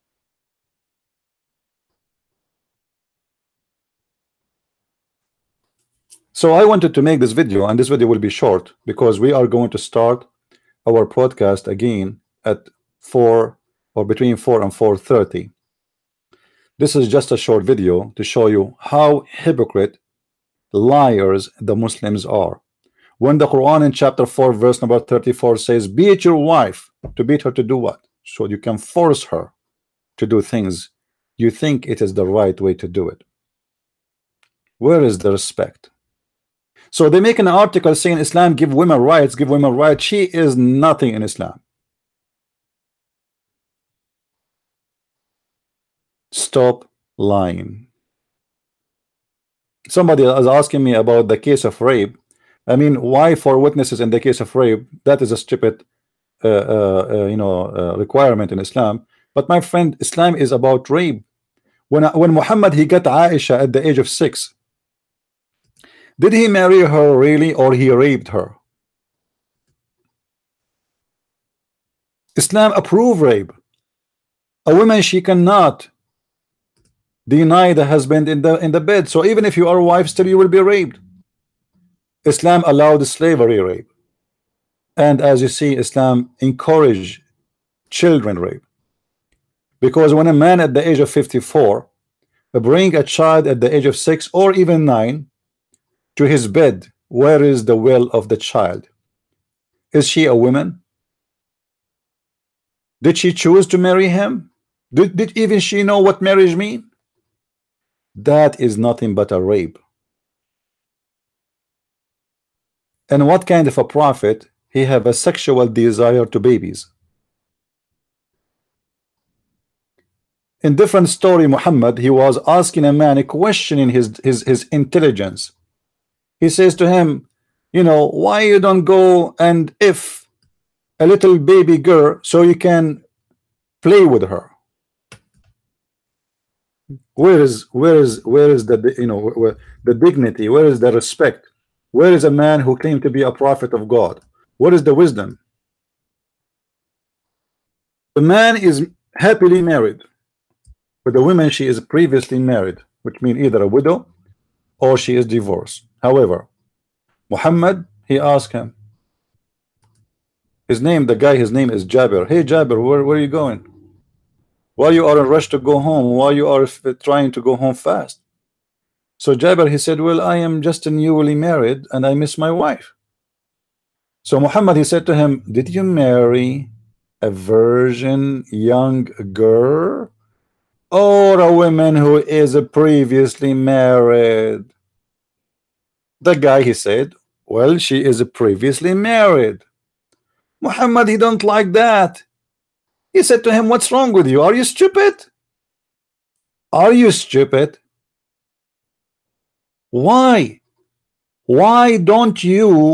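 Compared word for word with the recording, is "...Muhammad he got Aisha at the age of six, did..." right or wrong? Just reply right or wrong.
right.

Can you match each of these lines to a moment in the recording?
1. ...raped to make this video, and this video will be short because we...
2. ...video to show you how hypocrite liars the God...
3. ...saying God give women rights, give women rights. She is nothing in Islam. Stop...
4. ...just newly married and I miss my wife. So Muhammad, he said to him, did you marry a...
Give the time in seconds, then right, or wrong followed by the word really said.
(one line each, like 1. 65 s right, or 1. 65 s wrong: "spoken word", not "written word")
1. 6 s wrong: "wanted", not "raped"
2. 17 s wrong: "Muslims", not "God"
3. 37 s wrong: "Islam", not "God"
4. 170 s right.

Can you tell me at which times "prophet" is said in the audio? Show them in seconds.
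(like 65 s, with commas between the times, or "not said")
113 s, 143 s.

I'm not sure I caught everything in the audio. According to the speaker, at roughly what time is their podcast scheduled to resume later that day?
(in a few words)
between 4 and 4:30.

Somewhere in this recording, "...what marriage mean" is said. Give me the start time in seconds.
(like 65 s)
105 s.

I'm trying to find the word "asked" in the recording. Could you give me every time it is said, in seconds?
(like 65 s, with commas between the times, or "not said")
158 s.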